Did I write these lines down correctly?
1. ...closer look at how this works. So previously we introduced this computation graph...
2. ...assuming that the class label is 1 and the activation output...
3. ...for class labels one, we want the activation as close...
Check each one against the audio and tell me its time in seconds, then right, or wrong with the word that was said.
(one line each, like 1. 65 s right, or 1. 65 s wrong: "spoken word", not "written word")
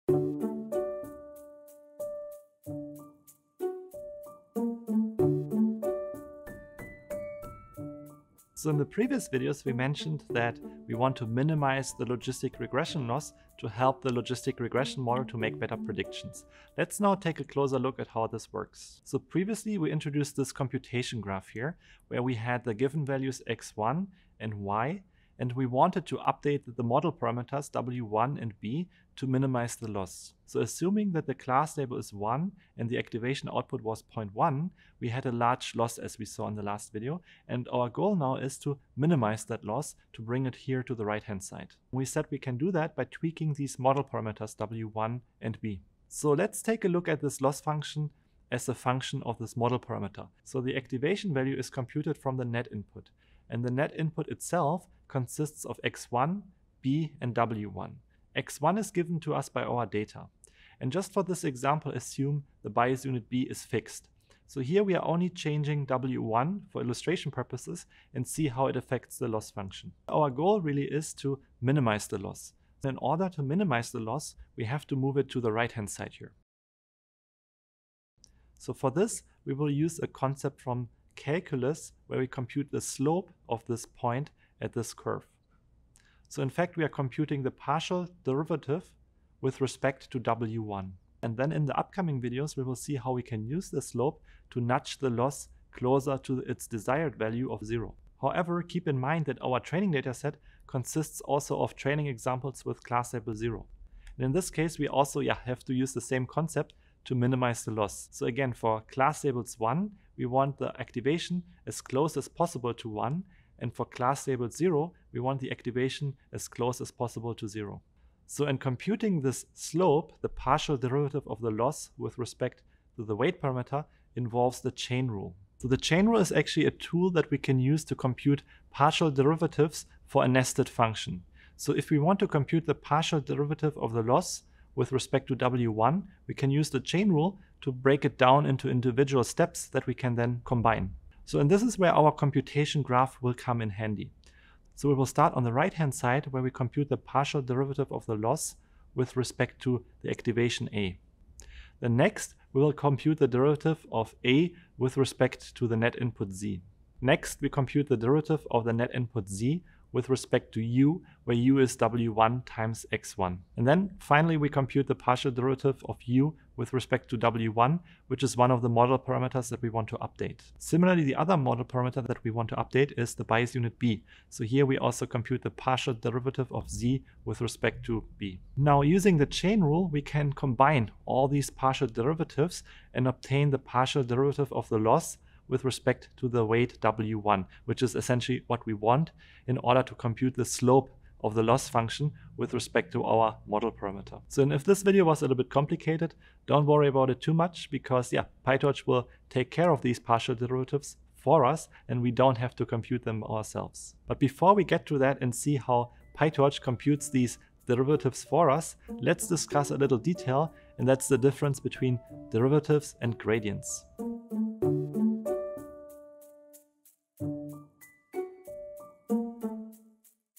1. 17 s right
2. 30 s right
3. 108 s right.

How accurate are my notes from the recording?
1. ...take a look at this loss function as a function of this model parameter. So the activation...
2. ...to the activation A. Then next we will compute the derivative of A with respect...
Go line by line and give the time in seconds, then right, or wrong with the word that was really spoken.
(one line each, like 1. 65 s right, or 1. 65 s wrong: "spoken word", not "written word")
1. 46 s right
2. 149 s right.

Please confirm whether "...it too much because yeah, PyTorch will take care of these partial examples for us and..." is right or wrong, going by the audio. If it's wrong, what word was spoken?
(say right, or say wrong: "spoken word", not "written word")
wrong: "derivatives", not "examples".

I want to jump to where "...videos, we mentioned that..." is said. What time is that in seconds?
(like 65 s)
9 s.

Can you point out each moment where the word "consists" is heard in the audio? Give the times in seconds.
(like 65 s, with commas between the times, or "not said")
55 s, 100 s.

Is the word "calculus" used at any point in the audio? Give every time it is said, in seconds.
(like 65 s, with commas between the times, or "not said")
81 s.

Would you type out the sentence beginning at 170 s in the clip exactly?
Similarly, the other model parameter that we want to update is the bias unit b.